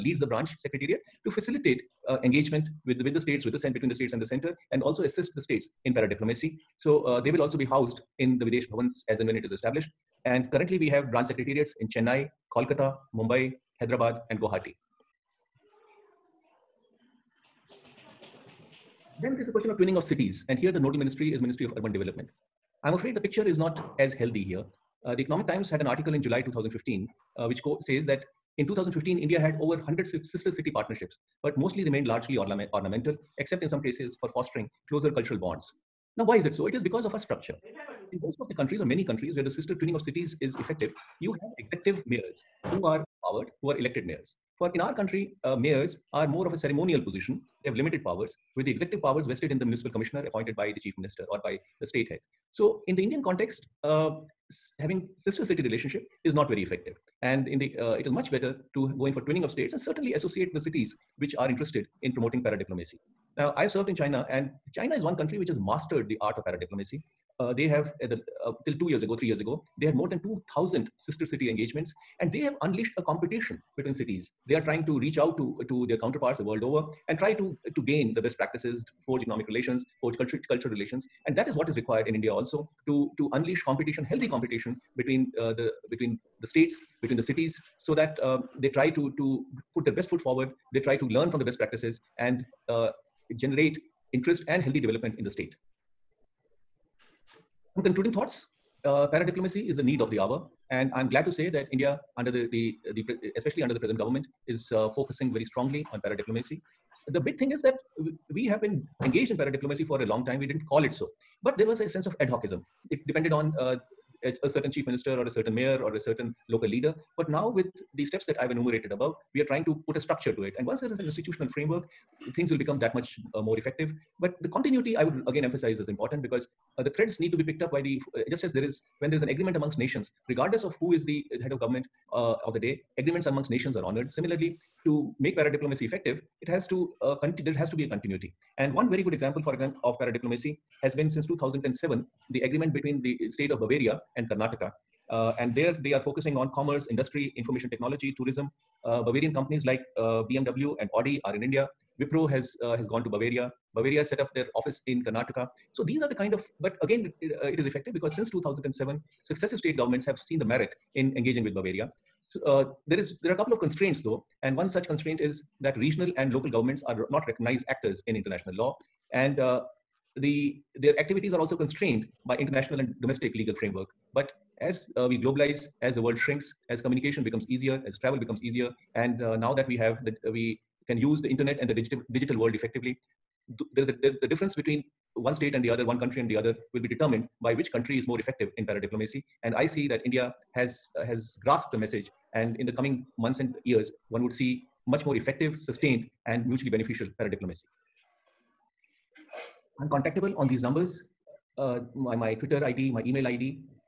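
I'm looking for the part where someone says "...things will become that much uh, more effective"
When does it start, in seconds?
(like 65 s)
122 s.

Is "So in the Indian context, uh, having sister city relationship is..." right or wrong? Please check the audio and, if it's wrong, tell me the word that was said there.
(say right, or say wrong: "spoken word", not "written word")
right.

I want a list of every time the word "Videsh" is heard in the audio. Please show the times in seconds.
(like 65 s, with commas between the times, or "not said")
8 s.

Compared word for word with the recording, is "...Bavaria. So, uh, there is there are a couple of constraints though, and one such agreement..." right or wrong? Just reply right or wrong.
wrong.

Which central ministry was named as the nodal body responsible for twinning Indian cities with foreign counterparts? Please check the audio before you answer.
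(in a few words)
Ministry of Urban Development.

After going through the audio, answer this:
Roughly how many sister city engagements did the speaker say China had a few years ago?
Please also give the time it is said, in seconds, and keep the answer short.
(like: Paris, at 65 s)
more than 2,000, at 69 s.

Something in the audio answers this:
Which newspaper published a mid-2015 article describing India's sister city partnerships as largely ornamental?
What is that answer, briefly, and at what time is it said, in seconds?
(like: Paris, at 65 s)
The Economic Times, at 25 s.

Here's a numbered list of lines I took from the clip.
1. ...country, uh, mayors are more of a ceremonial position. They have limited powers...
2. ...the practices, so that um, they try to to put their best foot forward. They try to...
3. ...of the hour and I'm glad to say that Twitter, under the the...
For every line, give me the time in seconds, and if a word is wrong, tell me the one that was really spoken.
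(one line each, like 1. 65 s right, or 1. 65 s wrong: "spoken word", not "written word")
1. 44 s right
2. 87 s wrong: "cities", not "practices"
3. 100 s wrong: "India", not "Twitter".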